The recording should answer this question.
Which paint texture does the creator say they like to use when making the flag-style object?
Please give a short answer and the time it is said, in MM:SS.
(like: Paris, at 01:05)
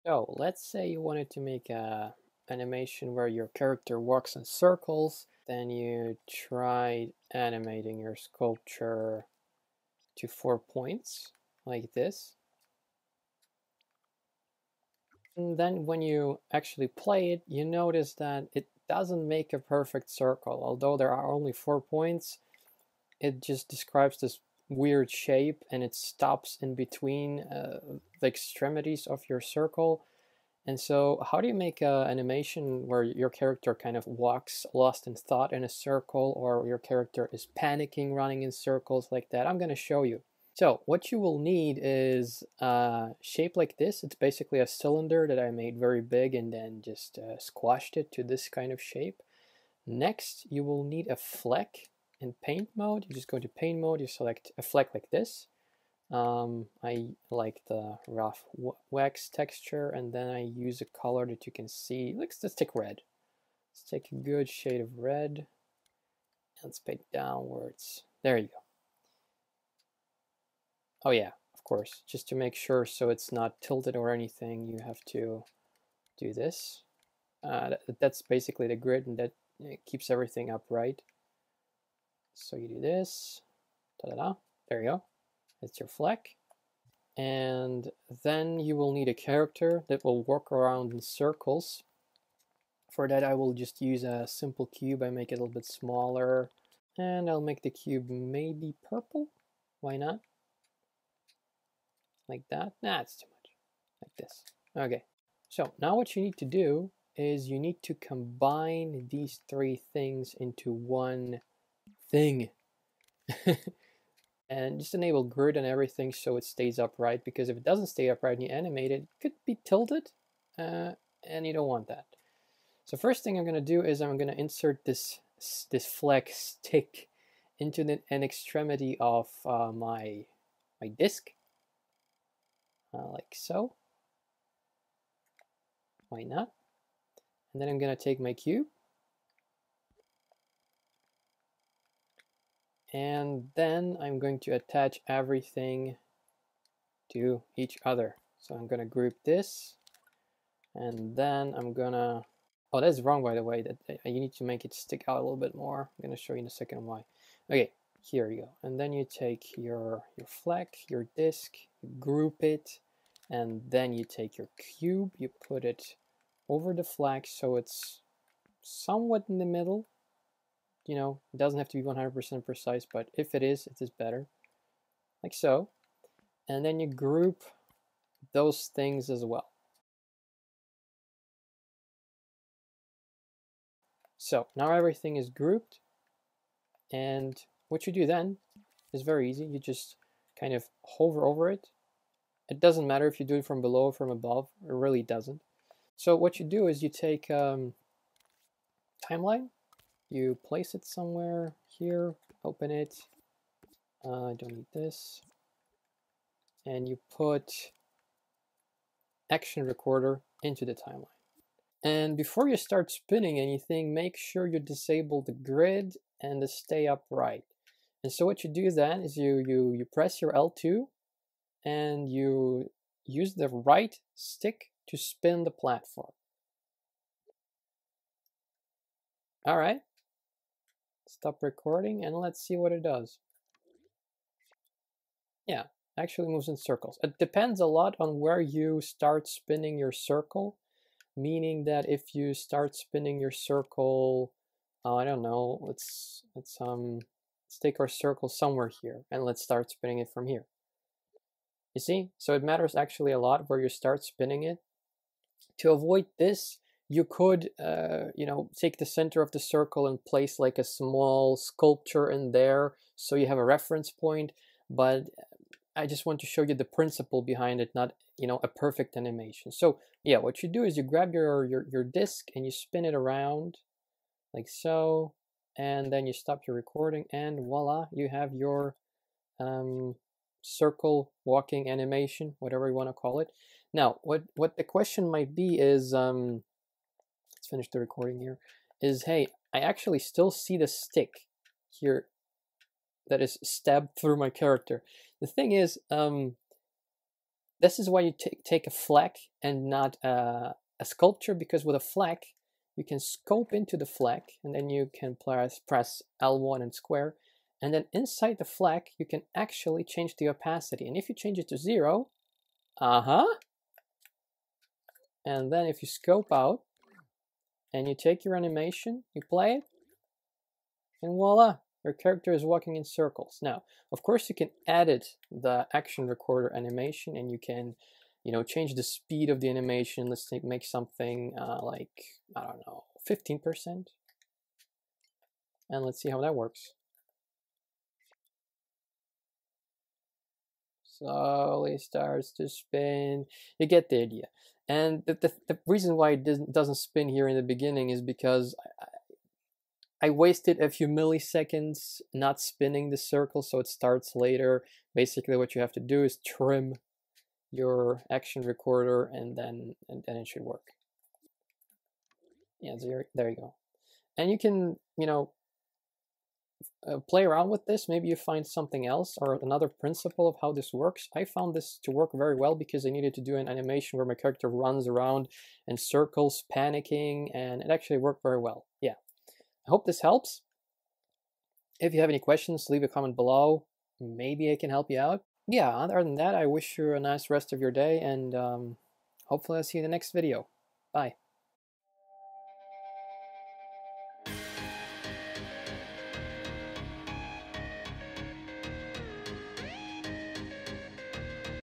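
Rough wax, at 00:58.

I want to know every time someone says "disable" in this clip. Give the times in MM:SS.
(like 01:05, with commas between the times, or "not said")
03:34.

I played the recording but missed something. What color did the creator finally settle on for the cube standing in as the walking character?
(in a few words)
Purple.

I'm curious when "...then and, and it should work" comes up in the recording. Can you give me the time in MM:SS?
05:59.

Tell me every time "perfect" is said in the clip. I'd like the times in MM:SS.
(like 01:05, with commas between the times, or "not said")
00:19, 04:28.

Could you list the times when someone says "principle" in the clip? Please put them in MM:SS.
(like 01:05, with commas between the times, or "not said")
04:26, 06:09.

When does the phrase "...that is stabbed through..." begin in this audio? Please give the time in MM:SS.
04:53.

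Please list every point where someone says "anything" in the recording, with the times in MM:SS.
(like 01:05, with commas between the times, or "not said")
01:14, 03:33.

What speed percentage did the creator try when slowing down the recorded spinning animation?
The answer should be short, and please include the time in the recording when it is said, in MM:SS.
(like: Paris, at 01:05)
15%, at 05:33.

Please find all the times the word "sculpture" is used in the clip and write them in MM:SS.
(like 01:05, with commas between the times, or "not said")
00:08, 04:21, 05:00.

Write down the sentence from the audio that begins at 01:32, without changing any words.
For that I will just use a simple cube, I make it a little bit smaller.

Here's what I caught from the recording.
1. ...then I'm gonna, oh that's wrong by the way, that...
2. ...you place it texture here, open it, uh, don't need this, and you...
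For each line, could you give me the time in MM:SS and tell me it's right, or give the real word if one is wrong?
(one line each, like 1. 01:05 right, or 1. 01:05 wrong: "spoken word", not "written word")
1. 02:31 right
2. 03:20 wrong: "somewhere", not "texture".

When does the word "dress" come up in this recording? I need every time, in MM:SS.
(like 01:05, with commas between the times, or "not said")
not said.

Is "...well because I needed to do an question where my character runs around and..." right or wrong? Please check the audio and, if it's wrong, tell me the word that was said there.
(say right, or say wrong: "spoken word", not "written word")
wrong: "animation", not "question".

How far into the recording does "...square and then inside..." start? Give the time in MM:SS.
05:06.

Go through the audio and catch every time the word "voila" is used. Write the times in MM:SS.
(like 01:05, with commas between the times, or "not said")
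04:37, 05:21.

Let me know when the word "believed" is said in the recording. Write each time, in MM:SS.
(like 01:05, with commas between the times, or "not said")
not said.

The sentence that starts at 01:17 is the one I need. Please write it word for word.
Uh, that, that's basically the grid and that keeps everything upright.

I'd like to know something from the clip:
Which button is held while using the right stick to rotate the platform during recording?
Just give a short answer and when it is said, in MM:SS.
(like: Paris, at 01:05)
L2, at 03:40.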